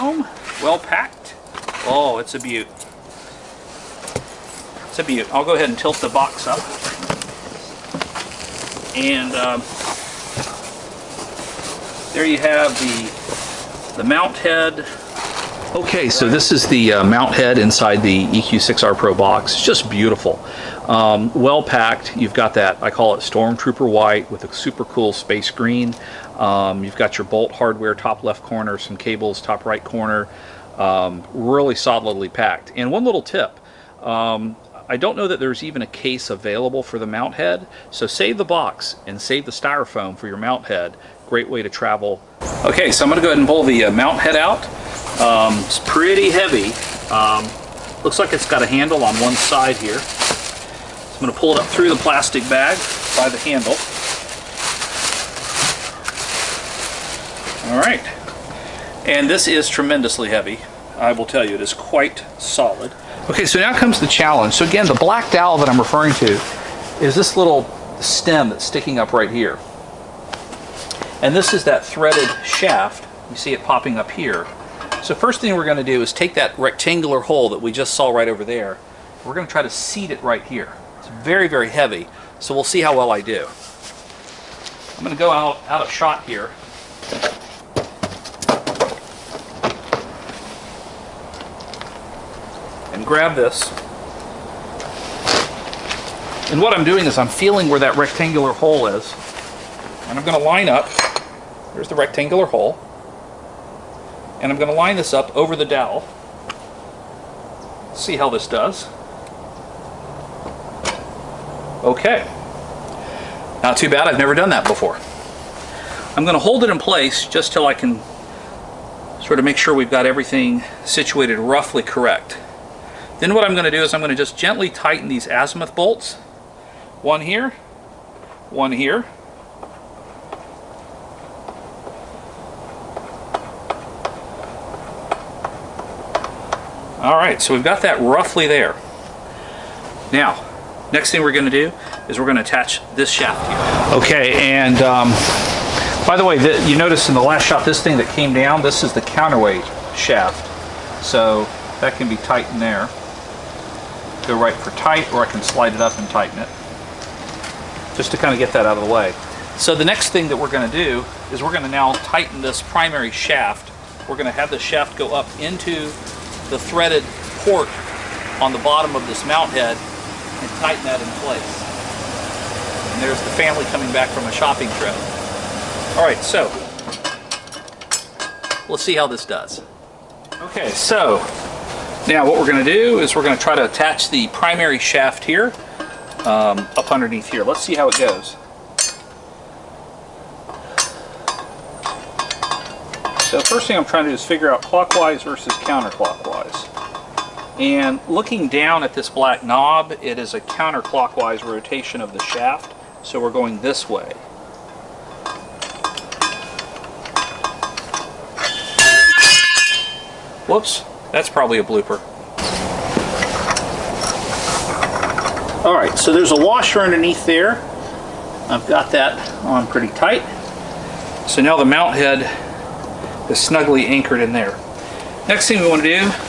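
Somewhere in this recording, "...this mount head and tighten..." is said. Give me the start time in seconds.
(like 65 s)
169 s.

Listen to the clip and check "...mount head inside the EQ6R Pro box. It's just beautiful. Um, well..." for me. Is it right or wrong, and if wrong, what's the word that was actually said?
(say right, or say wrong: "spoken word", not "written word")
right.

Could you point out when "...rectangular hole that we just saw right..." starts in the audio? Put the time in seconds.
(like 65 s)
76 s.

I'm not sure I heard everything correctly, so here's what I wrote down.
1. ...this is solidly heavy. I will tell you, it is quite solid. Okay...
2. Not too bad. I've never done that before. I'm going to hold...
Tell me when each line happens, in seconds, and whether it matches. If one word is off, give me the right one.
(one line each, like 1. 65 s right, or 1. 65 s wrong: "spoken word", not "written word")
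1. 59 s wrong: "tremendously", not "solidly"
2. 113 s right.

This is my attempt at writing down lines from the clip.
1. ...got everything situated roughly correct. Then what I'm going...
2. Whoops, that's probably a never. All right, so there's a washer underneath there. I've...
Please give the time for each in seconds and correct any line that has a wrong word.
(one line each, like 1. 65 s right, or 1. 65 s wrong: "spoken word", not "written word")
1. 119 s right
2. 210 s wrong: "blooper", not "never".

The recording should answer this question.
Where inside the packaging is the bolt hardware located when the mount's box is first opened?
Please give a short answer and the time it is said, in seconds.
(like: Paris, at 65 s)
Top left corner, at 27 s.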